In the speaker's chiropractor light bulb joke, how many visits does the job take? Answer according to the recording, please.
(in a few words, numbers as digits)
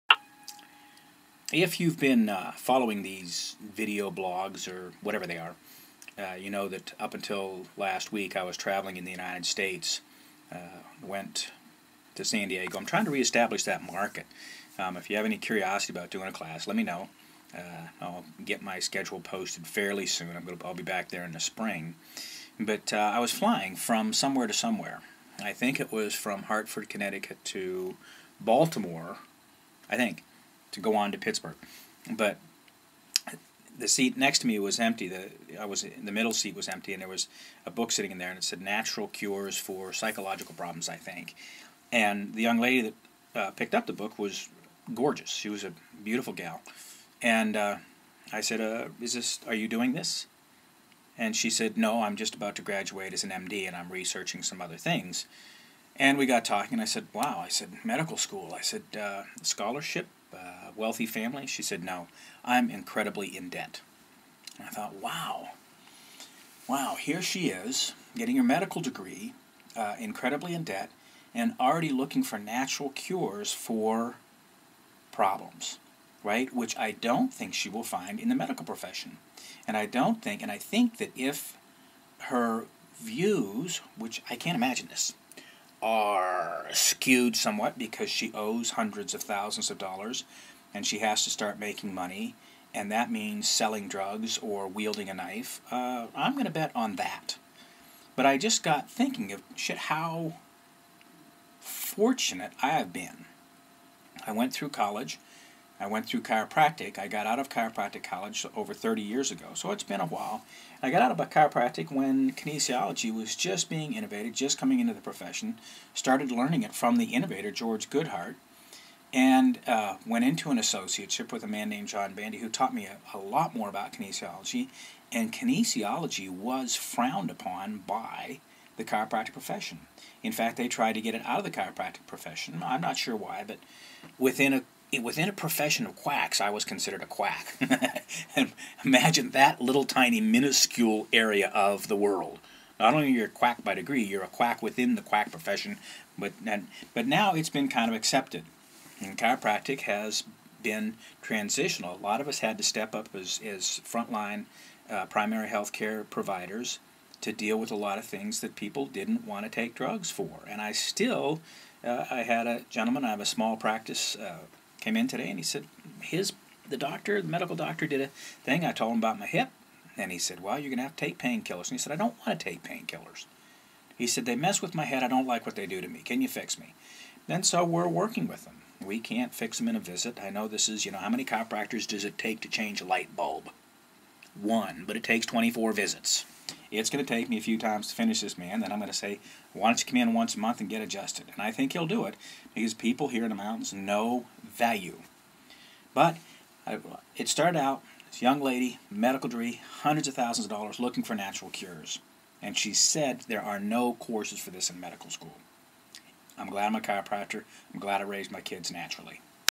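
24.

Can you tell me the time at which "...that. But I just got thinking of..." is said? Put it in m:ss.
1:36.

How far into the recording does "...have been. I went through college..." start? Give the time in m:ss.
1:42.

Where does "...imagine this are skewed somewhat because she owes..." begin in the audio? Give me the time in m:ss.
1:24.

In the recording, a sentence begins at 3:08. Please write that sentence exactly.
Then I'm going to say, why don't you come in once a month and get adjusted?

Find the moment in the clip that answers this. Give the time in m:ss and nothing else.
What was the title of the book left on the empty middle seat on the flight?
0:38.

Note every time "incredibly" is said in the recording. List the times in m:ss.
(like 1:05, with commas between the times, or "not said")
1:02, 1:09.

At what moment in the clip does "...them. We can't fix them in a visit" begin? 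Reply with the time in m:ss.
2:58.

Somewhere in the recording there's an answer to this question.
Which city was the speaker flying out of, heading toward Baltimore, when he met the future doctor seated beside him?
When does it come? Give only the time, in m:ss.
0:26.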